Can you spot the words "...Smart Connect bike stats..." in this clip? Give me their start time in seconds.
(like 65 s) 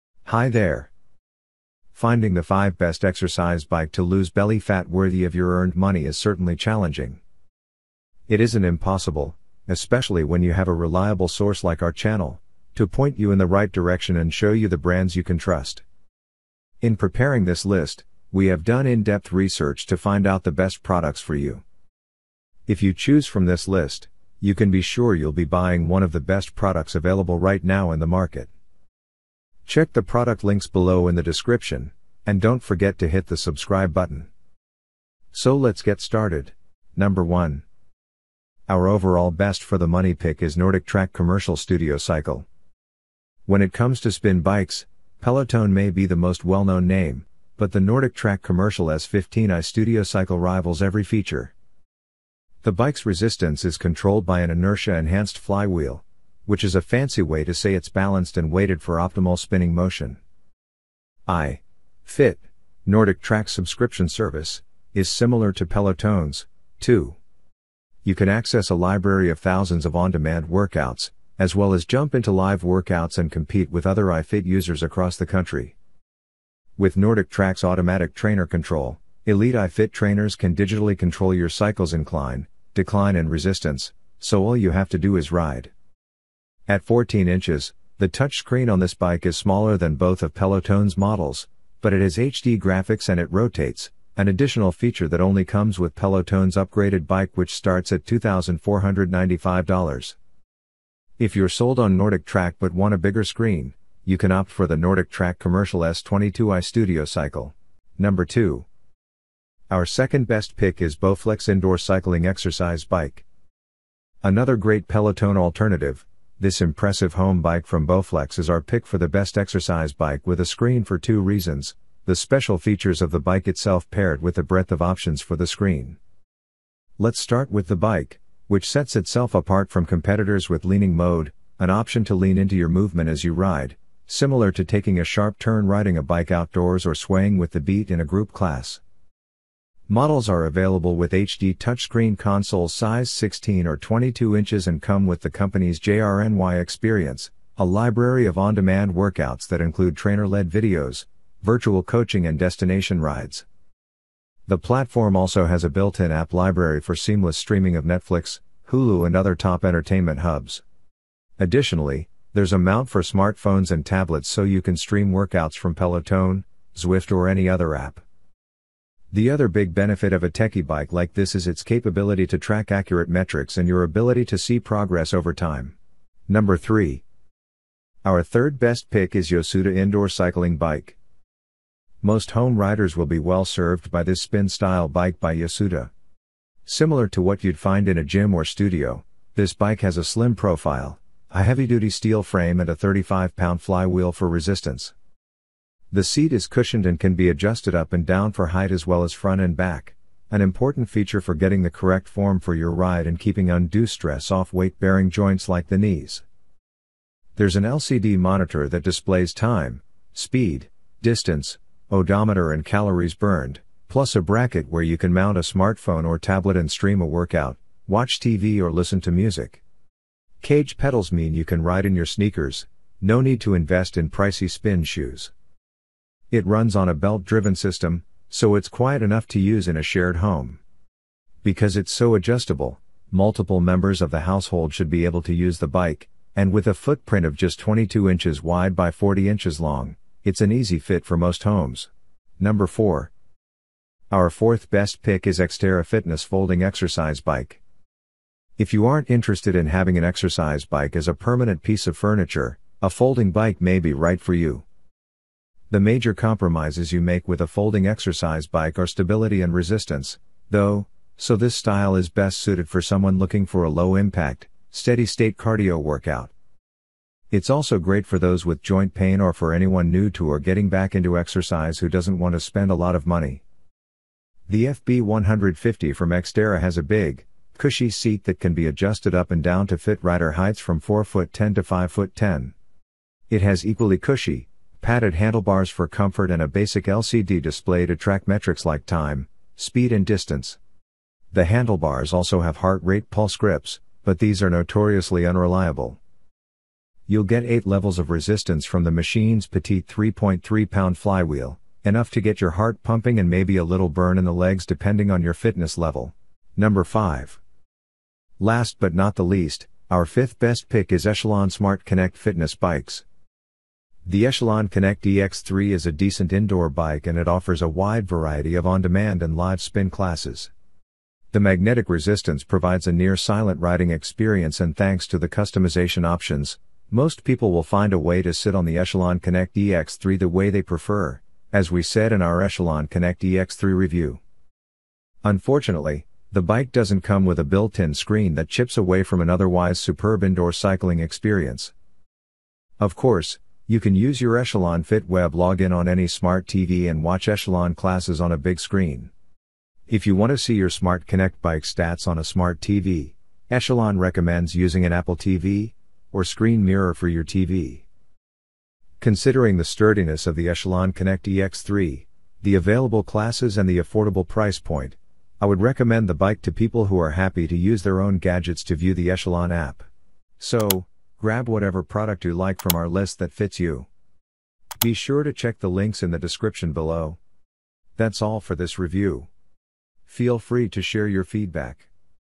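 350 s.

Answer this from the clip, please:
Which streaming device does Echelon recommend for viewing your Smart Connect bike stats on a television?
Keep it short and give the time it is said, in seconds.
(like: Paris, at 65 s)
Apple TV, at 354 s.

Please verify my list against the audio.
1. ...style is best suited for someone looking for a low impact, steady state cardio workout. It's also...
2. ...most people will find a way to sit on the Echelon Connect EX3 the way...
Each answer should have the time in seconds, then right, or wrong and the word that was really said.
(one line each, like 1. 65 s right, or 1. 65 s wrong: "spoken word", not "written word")
1. 261 s right
2. 326 s right.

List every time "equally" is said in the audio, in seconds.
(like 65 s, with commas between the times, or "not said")
283 s.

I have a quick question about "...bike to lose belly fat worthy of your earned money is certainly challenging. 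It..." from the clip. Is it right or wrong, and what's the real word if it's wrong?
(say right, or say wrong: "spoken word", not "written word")
right.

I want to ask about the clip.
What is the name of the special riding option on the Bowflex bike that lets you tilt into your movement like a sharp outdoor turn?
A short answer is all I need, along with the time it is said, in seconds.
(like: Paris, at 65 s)
leaning mode, at 130 s.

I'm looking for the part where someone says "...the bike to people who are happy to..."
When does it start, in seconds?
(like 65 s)
366 s.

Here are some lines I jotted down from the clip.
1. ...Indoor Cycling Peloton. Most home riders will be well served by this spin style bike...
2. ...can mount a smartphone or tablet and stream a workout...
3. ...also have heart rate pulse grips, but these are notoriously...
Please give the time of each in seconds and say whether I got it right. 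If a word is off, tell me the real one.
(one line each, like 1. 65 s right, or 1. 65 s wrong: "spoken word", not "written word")
1. 179 s wrong: "Bike", not "Peloton"
2. 214 s right
3. 292 s right.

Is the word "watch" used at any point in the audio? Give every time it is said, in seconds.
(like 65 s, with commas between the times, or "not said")
217 s, 347 s.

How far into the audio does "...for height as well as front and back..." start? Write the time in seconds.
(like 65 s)
198 s.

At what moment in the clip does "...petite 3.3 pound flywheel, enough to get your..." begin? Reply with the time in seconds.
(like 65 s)
299 s.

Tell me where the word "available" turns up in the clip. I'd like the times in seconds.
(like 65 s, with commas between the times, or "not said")
26 s, 140 s, 362 s.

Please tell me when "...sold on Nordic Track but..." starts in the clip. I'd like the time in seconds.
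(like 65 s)
101 s.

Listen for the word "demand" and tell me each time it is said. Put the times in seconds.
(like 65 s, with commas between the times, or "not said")
69 s, 148 s, 318 s.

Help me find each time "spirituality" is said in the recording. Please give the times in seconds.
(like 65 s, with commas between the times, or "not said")
not said.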